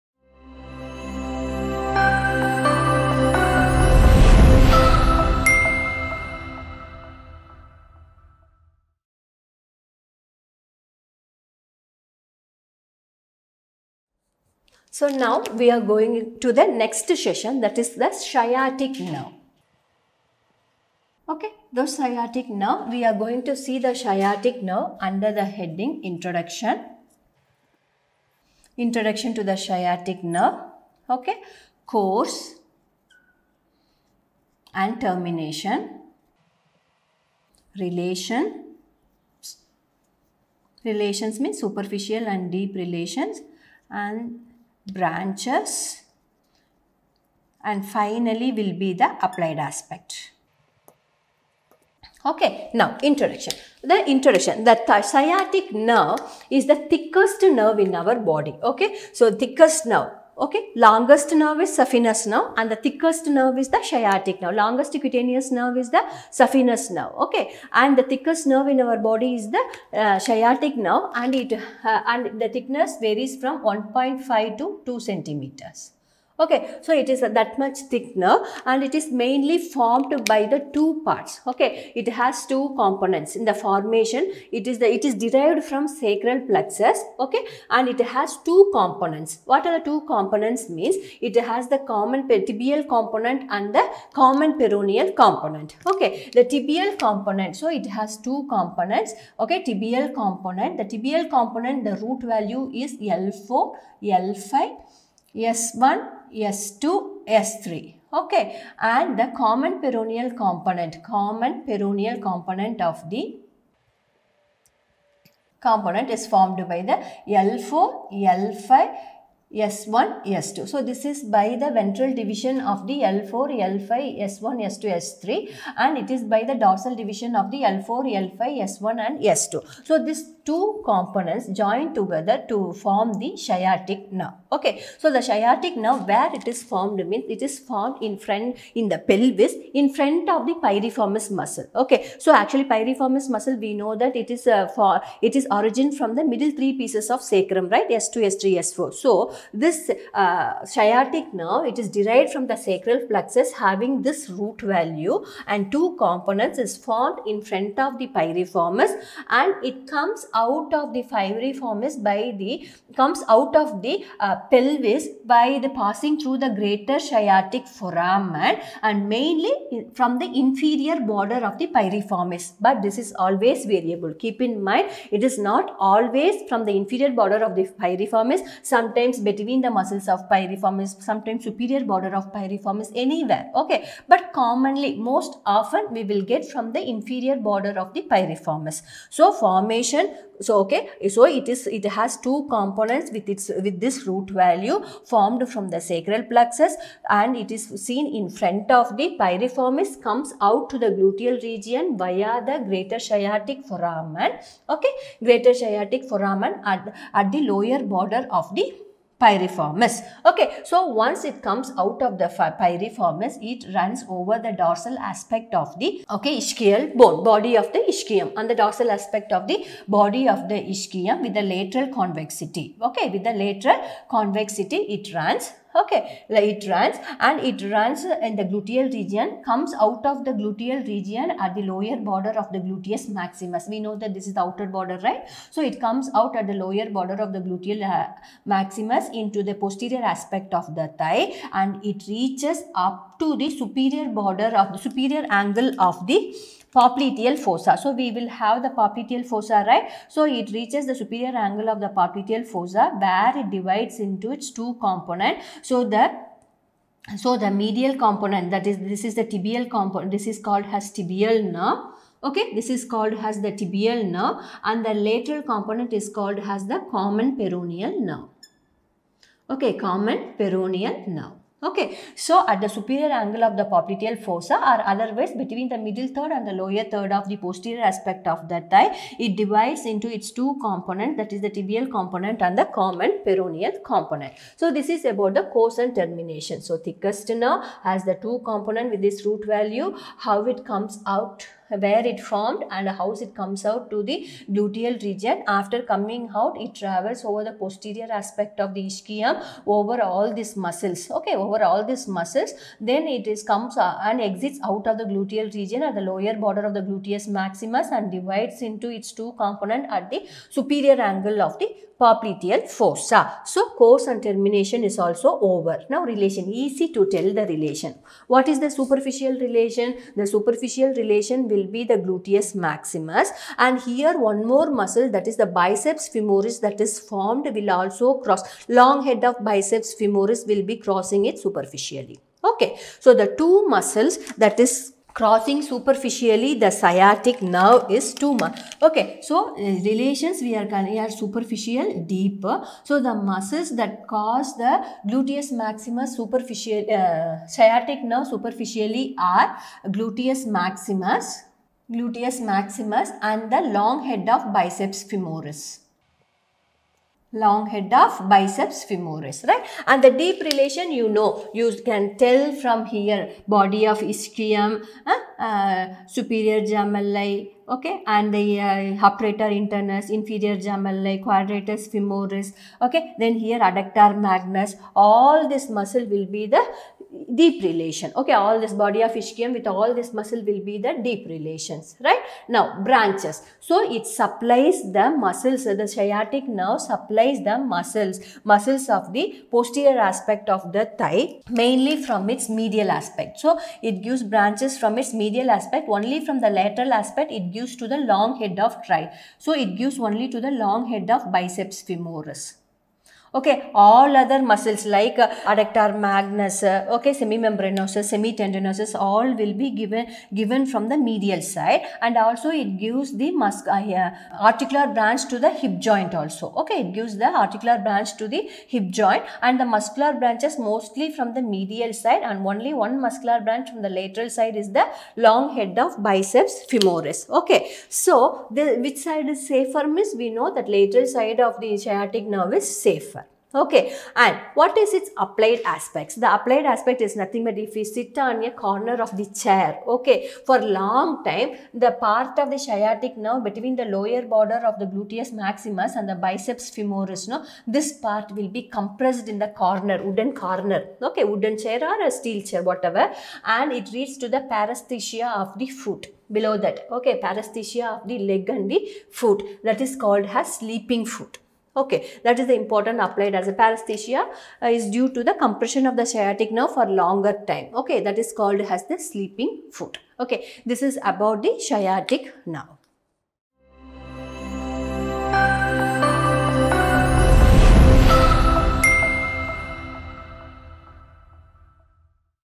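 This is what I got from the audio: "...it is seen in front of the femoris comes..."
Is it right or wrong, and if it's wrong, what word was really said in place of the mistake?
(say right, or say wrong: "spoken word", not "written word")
wrong: "piriformis", not "femoris".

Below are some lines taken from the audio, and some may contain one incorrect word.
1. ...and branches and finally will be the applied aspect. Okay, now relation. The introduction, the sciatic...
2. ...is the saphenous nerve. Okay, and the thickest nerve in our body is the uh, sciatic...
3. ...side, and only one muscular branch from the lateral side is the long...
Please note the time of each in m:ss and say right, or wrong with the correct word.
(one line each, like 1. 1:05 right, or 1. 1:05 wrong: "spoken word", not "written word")
1. 0:43 wrong: "introduction", not "relation"
2. 1:05 right
3. 7:01 right.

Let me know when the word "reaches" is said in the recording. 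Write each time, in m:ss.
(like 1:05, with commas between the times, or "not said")
4:02, 4:10.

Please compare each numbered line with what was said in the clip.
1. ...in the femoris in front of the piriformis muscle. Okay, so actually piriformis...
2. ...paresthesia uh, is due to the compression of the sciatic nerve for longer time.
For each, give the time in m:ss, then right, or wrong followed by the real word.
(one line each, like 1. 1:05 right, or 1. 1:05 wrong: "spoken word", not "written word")
1. 2:18 wrong: "pelvis", not "femoris"
2. 7:43 right.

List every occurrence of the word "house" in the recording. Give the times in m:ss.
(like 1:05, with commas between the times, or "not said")
not said.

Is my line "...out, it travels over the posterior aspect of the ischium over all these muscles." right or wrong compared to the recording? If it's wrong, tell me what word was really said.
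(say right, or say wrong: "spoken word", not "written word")
right.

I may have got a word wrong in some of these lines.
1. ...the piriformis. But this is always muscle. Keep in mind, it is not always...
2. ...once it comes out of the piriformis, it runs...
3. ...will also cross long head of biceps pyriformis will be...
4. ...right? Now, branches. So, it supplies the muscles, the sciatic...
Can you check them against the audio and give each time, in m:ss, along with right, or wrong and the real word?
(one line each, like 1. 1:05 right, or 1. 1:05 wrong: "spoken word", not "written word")
1. 2:51 wrong: "variable", not "muscle"
2. 3:31 wrong: "pyriformis", not "piriformis"
3. 5:27 wrong: "femoris", not "pyriformis"
4. 6:22 right.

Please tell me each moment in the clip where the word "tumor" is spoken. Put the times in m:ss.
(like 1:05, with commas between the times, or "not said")
5:38.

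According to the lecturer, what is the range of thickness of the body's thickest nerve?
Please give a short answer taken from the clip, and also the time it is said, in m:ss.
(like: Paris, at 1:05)
1.5 to 2 centimeters, at 1:13.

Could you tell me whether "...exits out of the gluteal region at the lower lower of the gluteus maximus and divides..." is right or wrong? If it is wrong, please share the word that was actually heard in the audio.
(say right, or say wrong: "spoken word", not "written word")
wrong: "border", not "lower".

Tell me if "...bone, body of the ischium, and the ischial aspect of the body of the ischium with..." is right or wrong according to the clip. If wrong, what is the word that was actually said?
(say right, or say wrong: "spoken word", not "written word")
wrong: "dorsal", not "ischial".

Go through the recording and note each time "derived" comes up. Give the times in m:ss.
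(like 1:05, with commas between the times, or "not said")
1:25, 2:31.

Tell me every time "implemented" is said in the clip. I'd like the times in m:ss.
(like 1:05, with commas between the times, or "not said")
not said.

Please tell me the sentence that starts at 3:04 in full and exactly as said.
But commonly, most often we will get from the inferior border of the piriformis.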